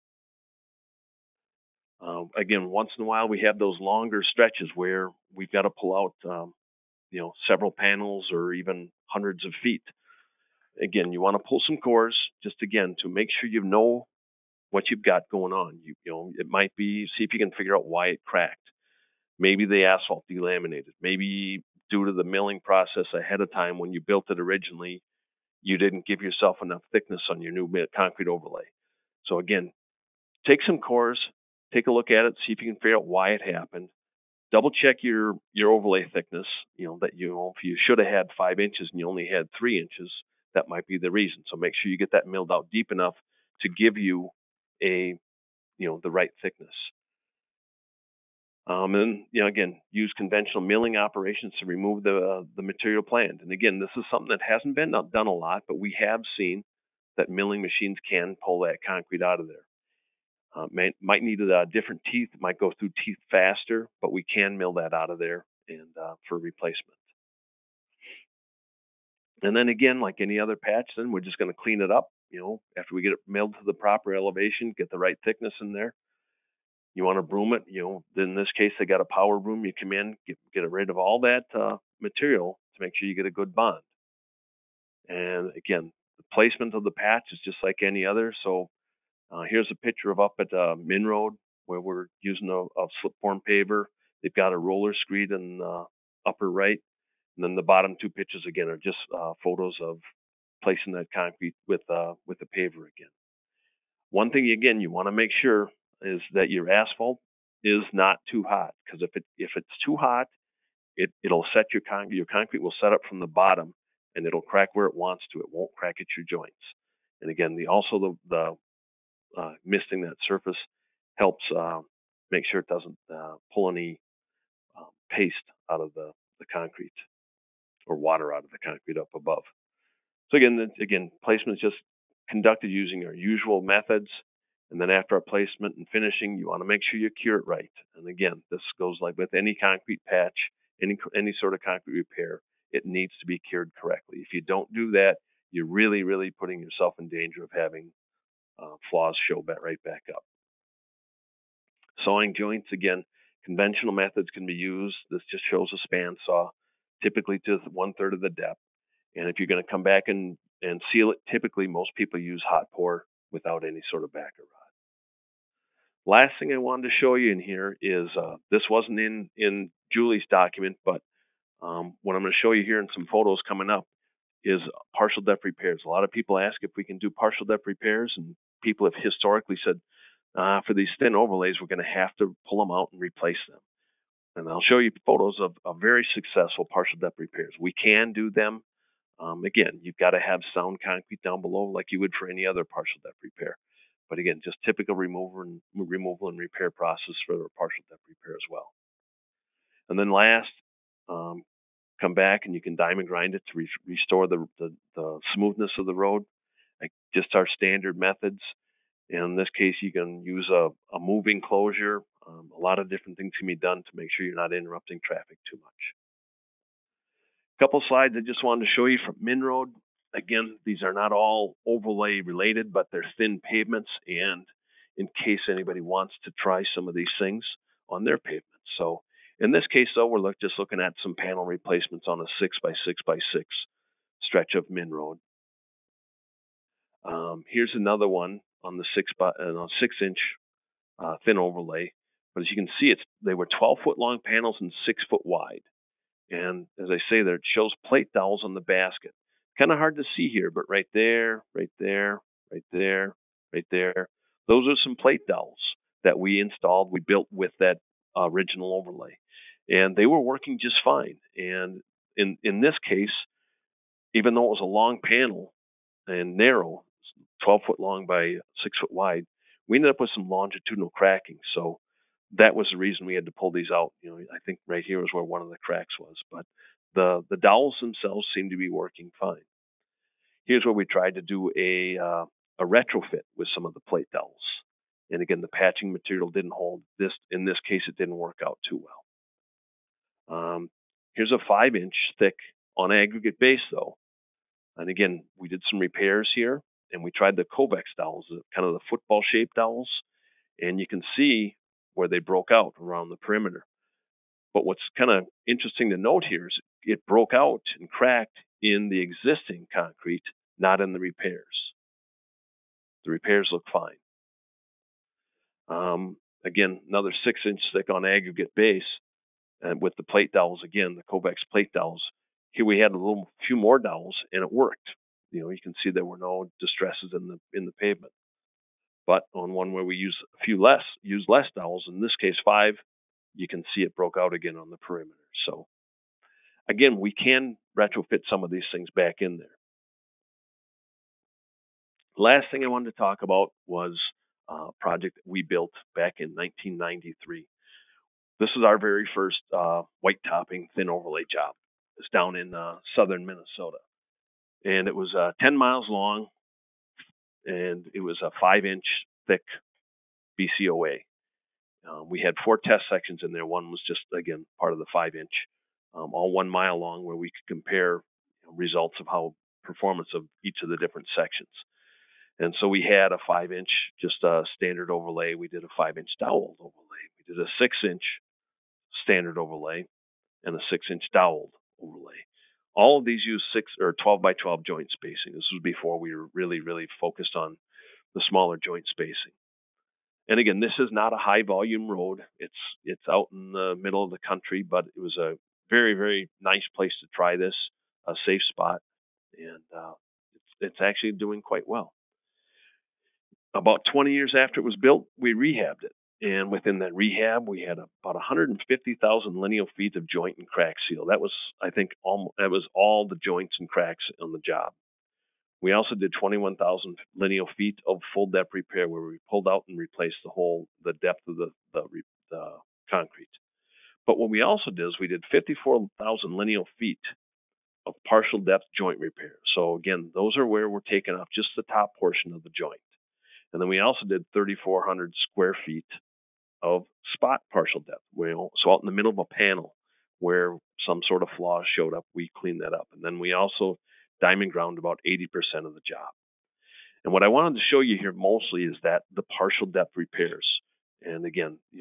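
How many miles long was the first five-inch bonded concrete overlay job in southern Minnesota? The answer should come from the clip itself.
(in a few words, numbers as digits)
10 miles.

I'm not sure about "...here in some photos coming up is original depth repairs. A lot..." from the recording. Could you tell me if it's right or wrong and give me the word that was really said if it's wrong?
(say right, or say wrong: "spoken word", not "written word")
wrong: "partial", not "original".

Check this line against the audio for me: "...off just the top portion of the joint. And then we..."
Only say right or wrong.
right.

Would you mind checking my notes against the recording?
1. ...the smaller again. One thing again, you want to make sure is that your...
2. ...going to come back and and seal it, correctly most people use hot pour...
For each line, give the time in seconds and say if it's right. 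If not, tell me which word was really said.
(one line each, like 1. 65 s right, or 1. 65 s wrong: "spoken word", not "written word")
1. 102 s wrong: "paver", not "smaller"
2. 159 s wrong: "typically", not "correctly".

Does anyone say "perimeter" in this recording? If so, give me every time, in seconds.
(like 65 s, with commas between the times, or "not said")
303 s, 334 s.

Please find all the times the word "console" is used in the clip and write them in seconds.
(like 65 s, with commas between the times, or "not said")
not said.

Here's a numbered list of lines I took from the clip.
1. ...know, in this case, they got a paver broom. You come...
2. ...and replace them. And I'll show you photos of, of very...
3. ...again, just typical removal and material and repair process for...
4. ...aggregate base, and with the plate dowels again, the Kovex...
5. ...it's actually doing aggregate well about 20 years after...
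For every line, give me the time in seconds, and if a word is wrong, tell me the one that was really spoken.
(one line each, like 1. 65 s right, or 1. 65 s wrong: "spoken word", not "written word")
1. 77 s wrong: "power", not "paver"
2. 182 s right
3. 194 s wrong: "removal", not "material"
4. 318 s right
5. 400 s wrong: "quite", not "aggregate".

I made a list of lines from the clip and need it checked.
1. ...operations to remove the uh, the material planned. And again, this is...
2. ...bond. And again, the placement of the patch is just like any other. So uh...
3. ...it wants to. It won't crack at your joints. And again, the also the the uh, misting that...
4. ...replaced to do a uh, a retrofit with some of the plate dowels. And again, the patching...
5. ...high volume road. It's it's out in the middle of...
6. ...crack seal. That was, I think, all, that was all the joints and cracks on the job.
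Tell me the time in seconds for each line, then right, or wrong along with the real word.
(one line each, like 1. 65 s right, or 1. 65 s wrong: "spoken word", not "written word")
1. 50 s right
2. 83 s right
3. 114 s right
4. 280 s wrong: "tried", not "replaced"
5. 391 s right
6. 410 s right.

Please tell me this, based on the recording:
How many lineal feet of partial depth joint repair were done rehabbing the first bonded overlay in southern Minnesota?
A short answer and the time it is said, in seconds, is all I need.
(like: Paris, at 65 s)
54,000, at 425 s.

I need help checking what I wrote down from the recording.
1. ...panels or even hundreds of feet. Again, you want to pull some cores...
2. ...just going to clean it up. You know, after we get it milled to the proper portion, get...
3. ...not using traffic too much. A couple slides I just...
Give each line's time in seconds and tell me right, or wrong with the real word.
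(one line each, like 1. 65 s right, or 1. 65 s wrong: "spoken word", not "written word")
1. 7 s right
2. 71 s wrong: "elevation", not "portion"
3. 214 s wrong: "interrupting", not "using".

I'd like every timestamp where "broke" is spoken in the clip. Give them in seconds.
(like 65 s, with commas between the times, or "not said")
302 s, 307 s, 333 s.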